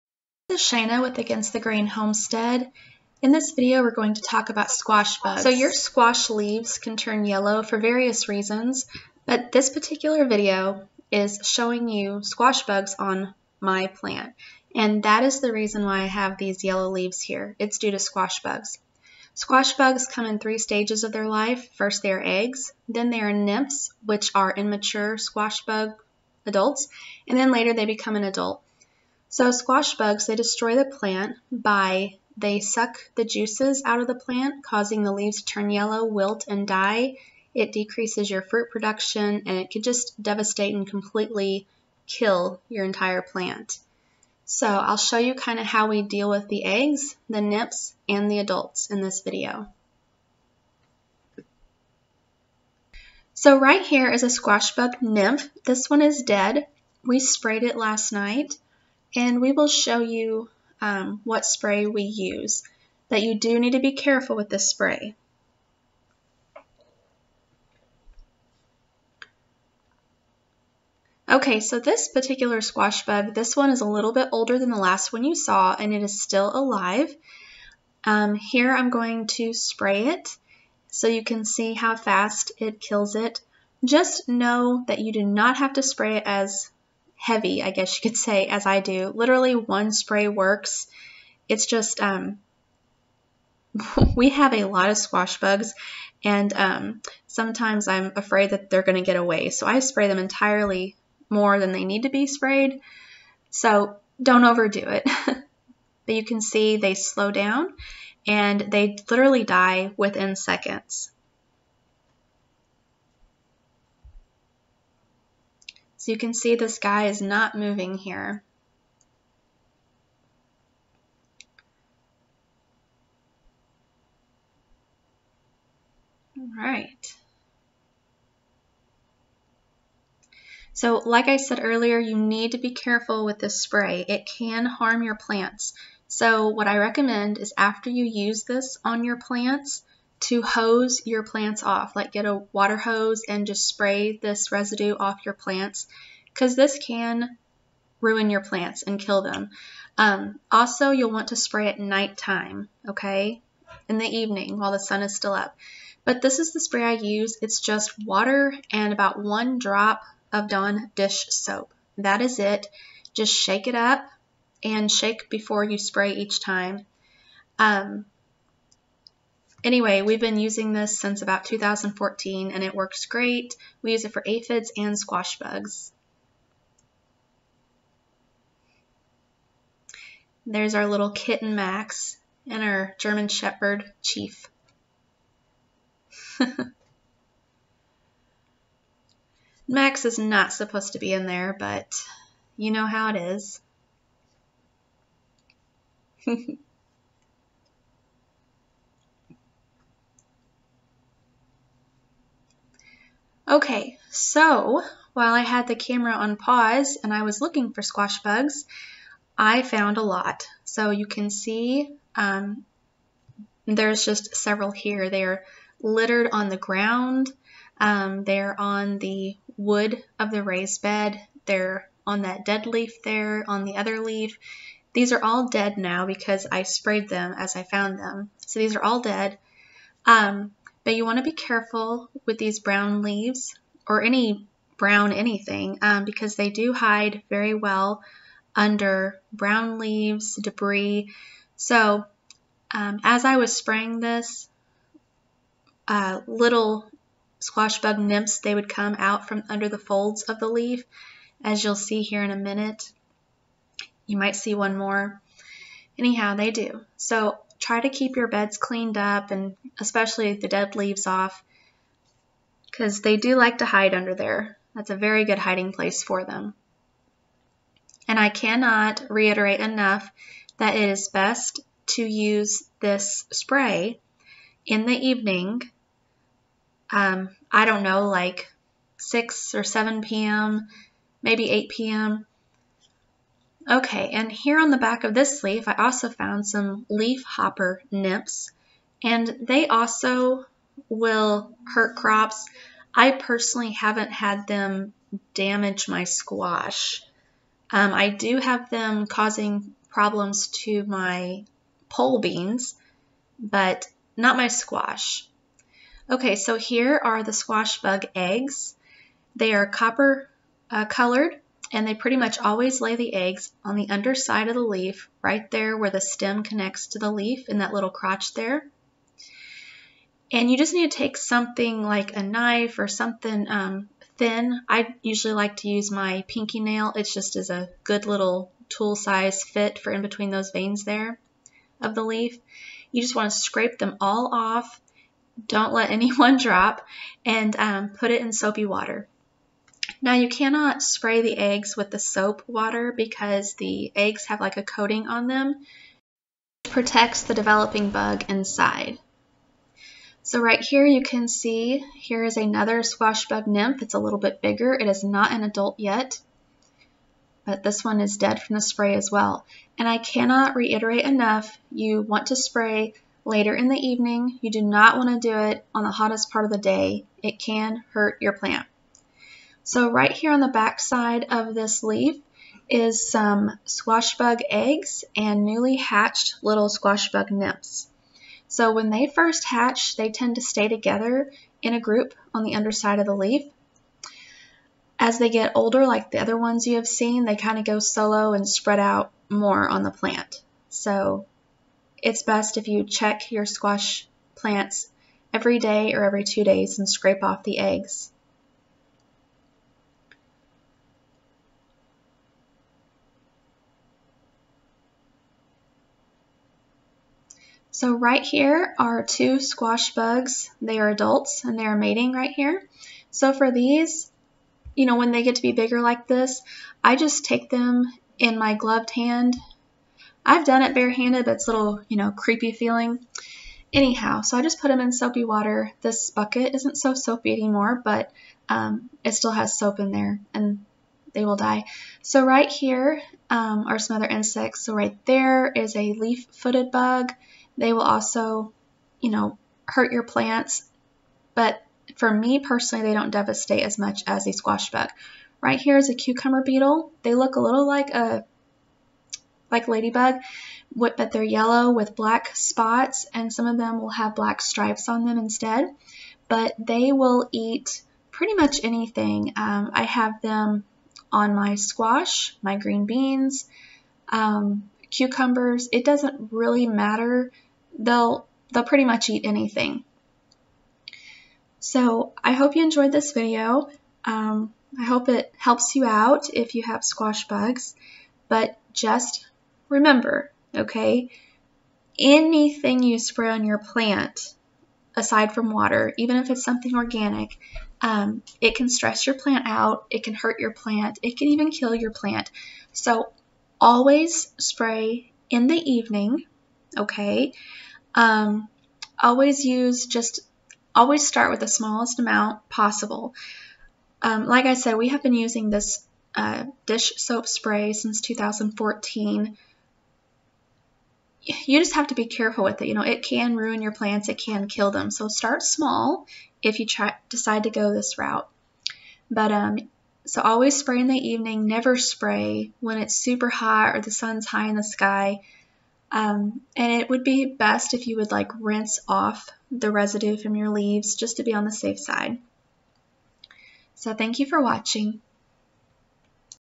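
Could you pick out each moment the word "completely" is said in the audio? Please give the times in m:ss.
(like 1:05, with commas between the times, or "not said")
0:40.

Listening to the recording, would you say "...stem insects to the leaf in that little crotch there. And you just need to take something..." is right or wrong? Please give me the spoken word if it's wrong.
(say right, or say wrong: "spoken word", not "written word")
wrong: "connects", not "insects".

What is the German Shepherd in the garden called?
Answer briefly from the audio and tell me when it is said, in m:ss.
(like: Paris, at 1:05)
Chief, at 3:04.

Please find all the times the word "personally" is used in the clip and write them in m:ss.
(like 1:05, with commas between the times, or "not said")
4:53, 7:22.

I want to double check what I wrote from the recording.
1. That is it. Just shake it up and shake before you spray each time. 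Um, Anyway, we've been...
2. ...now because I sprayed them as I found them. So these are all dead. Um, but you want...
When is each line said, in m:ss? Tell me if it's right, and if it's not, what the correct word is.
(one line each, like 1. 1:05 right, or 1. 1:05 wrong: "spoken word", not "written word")
1. 2:41 right
2. 3:45 right.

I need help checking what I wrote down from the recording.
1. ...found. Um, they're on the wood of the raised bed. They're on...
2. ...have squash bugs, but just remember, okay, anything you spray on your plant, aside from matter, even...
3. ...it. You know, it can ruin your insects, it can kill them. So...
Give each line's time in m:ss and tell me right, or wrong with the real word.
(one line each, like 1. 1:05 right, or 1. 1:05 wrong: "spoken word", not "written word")
1. 3:36 wrong: "ground", not "found"
2. 7:56 wrong: "water", not "matter"
3. 8:32 wrong: "plants", not "insects".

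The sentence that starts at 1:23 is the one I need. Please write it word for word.
Just know that you do not have to spray it as heavy, I guess you could say, as I do.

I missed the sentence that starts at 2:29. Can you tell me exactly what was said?
Um, also, you'll want to spray at nighttime, okay, in the evening while the sun is still up.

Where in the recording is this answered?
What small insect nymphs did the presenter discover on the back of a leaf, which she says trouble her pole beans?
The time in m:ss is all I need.
4:46.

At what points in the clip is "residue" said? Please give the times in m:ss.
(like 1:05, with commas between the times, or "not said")
2:24, 8:49.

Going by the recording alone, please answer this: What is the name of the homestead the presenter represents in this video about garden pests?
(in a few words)
Against the Grain Homestead.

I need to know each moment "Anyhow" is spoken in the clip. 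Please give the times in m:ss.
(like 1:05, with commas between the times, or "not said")
4:15, 7:03.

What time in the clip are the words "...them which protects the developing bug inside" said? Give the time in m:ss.
5:45.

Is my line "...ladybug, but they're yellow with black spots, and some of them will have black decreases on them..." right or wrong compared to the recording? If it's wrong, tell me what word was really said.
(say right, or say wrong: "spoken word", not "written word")
wrong: "stripes", not "decreases".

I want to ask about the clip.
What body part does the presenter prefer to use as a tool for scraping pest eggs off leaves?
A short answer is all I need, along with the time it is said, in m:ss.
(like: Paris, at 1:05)
pinky nail, at 5:26.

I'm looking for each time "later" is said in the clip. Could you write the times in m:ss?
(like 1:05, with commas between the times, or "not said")
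0:27, 6:03.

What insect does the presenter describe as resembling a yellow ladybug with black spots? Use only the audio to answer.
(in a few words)
cucumber beetle.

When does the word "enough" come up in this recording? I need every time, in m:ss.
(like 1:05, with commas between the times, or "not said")
4:29, 6:01.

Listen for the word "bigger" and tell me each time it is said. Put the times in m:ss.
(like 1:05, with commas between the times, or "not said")
5:54, 6:55.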